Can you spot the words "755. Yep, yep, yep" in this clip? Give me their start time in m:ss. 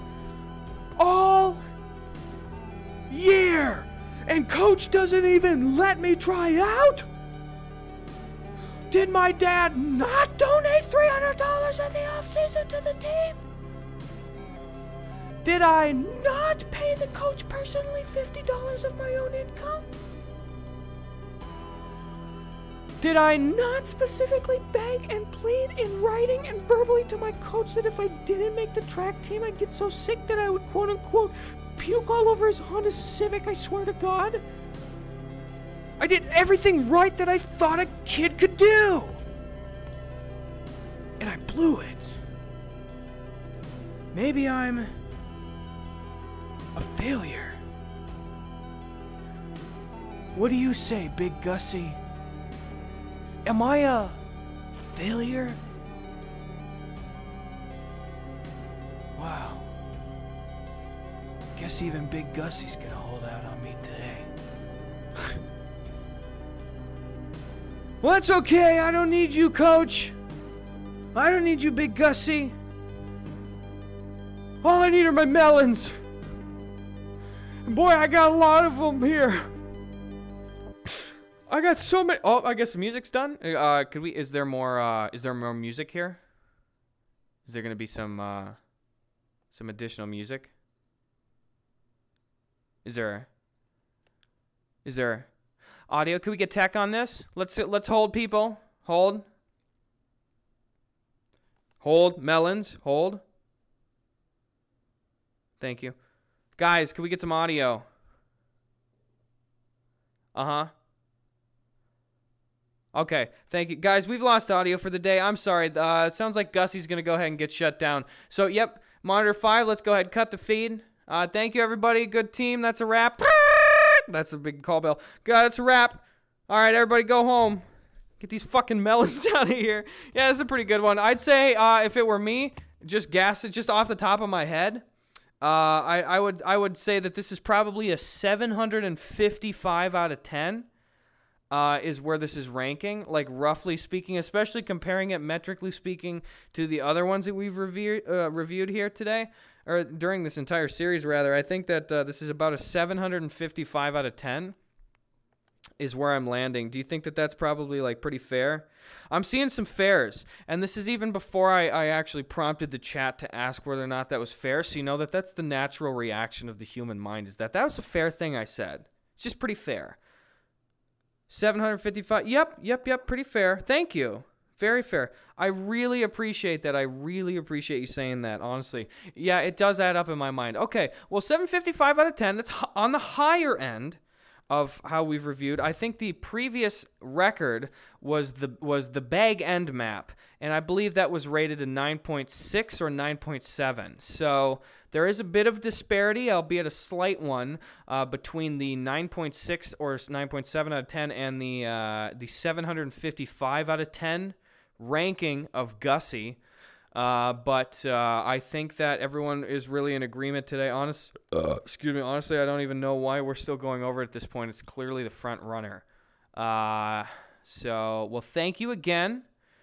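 2:51.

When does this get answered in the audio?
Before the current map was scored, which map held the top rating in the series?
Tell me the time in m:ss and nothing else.
3:09.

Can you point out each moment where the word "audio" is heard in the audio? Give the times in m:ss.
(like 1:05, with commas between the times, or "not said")
1:35, 1:47, 1:54.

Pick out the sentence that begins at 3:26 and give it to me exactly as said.
Uh, but uh, I think that everyone is really in agreement today.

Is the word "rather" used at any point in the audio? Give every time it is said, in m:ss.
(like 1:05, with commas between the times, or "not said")
2:31.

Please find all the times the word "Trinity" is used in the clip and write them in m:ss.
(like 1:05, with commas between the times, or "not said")
not said.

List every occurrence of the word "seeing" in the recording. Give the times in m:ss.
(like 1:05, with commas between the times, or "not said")
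2:39.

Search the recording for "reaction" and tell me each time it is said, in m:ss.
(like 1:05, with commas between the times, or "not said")
2:45.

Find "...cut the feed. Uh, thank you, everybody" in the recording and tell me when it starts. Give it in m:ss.
2:00.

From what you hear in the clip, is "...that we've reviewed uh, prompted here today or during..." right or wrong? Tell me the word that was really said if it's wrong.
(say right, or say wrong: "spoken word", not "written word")
wrong: "reviewed", not "prompted".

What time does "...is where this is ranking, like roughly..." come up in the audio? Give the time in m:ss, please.
2:21.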